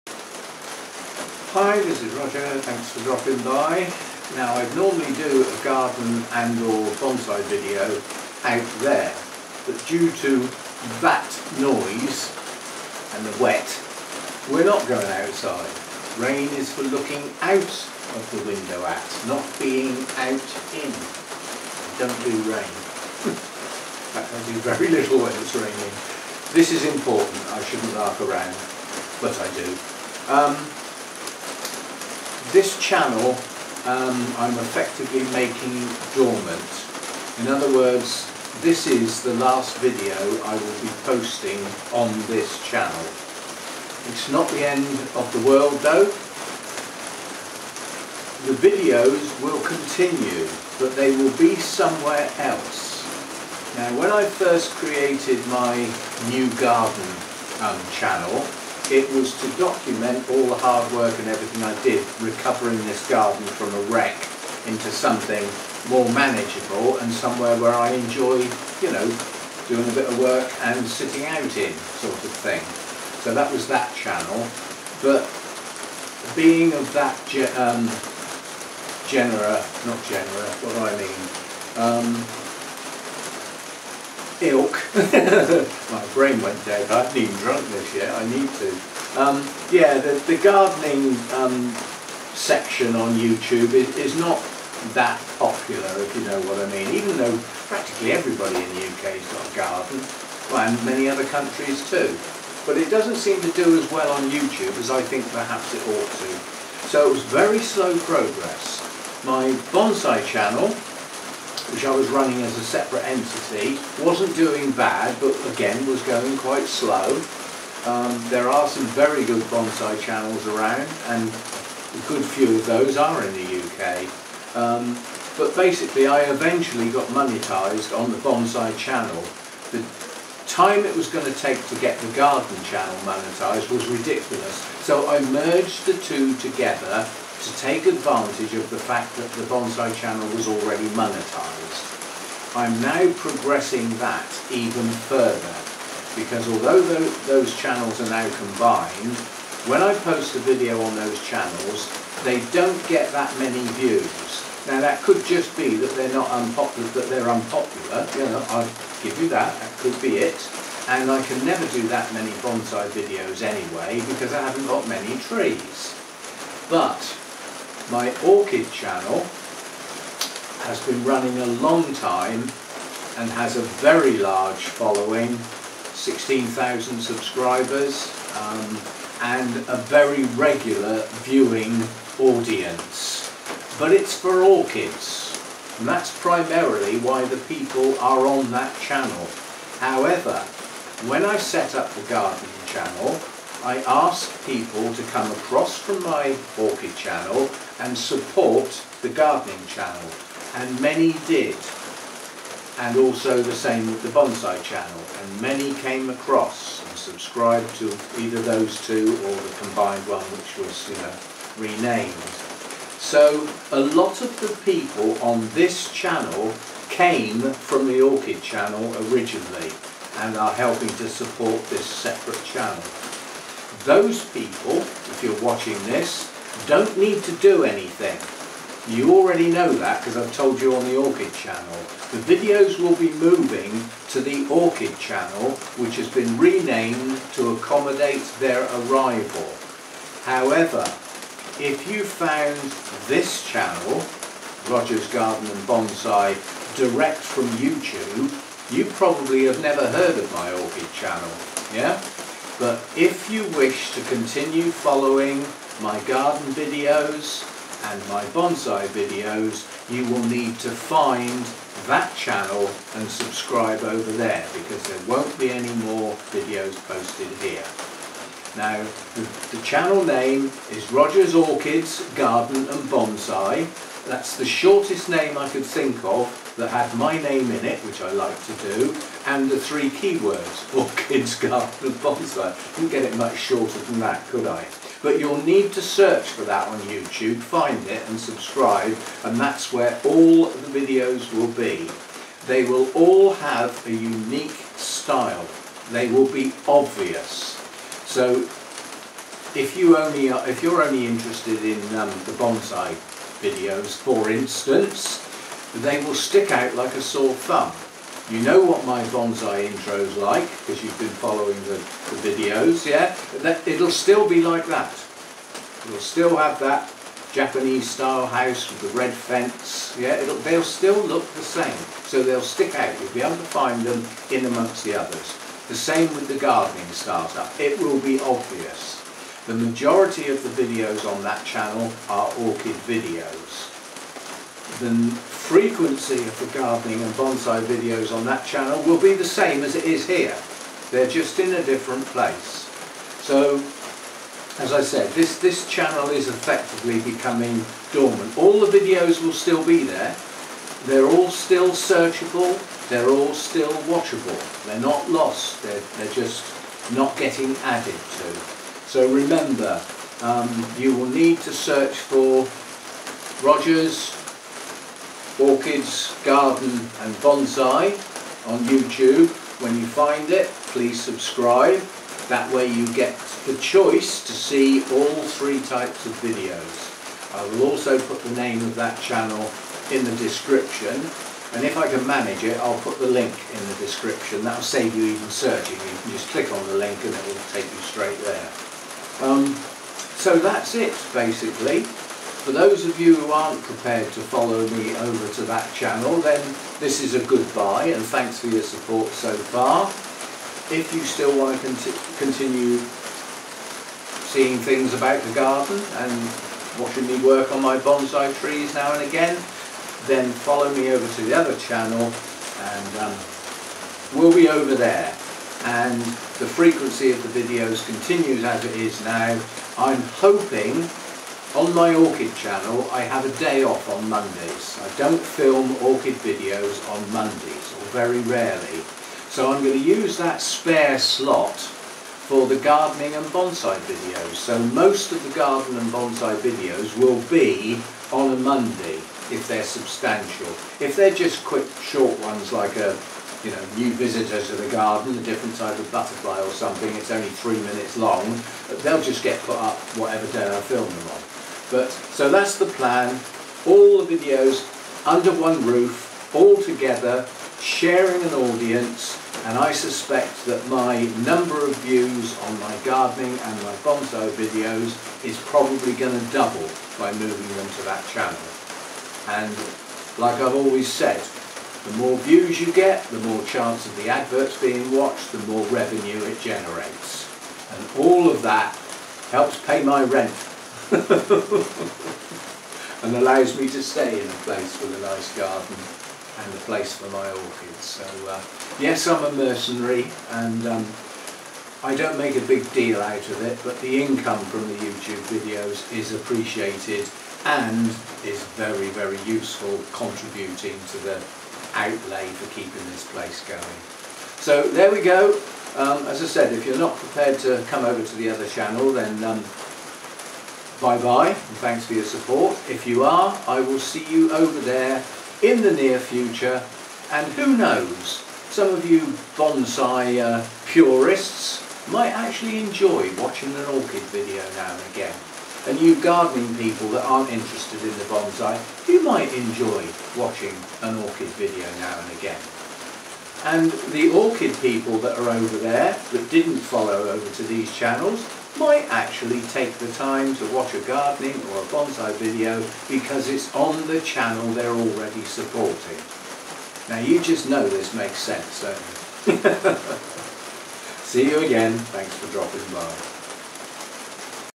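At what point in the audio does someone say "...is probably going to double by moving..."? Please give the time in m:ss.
7:45.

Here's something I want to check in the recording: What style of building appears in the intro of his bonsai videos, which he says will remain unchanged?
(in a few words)
Japanese style house.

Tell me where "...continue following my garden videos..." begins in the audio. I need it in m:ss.
4:14.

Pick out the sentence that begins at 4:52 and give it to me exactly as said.
They will all have a unique style.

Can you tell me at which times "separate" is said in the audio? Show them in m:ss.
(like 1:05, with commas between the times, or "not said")
1:52, 3:41.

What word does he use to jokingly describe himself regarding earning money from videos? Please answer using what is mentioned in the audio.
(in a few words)
Mercenary.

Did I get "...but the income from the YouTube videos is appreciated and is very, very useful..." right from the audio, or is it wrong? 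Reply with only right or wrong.
right.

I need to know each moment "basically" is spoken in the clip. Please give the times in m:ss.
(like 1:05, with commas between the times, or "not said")
2:05, 6:31.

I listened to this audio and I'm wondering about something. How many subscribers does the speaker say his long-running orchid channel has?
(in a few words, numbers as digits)
16,000.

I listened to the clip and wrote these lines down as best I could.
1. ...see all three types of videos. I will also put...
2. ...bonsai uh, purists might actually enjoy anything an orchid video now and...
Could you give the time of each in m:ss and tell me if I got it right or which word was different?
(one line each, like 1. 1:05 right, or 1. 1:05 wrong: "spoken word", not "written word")
1. 6:14 right
2. 8:39 wrong: "watching", not "anything".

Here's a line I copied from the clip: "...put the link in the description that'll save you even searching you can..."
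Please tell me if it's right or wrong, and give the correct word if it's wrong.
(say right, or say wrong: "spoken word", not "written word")
right.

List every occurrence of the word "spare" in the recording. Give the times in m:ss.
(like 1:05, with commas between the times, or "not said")
7:10.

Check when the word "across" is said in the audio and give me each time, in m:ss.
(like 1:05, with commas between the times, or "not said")
3:15, 3:26.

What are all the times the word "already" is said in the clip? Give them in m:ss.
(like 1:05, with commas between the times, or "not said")
2:20, 3:49, 9:04.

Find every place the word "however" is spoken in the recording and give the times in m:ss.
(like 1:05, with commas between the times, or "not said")
3:09, 4:00.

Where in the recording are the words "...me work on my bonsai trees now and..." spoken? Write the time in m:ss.
6:47.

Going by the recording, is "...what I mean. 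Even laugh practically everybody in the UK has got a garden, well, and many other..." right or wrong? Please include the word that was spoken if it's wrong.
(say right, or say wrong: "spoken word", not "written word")
wrong: "though", not "laugh".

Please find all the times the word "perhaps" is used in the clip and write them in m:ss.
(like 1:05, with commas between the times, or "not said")
1:45.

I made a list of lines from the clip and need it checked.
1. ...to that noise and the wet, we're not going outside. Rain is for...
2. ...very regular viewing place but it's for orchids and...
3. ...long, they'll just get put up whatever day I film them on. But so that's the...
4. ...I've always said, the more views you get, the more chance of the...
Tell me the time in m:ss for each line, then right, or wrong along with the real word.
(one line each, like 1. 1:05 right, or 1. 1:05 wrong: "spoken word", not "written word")
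1. 0:10 right
2. 2:59 wrong: "audience", not "place"
3. 7:27 right
4. 7:50 right.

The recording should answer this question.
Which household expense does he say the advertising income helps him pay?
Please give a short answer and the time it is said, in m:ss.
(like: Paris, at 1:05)
Rent, at 8:00.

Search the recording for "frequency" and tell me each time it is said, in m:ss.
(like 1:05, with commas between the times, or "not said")
5:35, 6:56.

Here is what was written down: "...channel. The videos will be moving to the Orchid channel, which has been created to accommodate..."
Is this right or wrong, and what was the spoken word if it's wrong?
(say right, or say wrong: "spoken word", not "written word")
wrong: "renamed", not "created".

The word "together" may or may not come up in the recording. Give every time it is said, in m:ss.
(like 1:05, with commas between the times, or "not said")
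2:16, 7:36.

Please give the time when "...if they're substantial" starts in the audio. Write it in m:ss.
7:19.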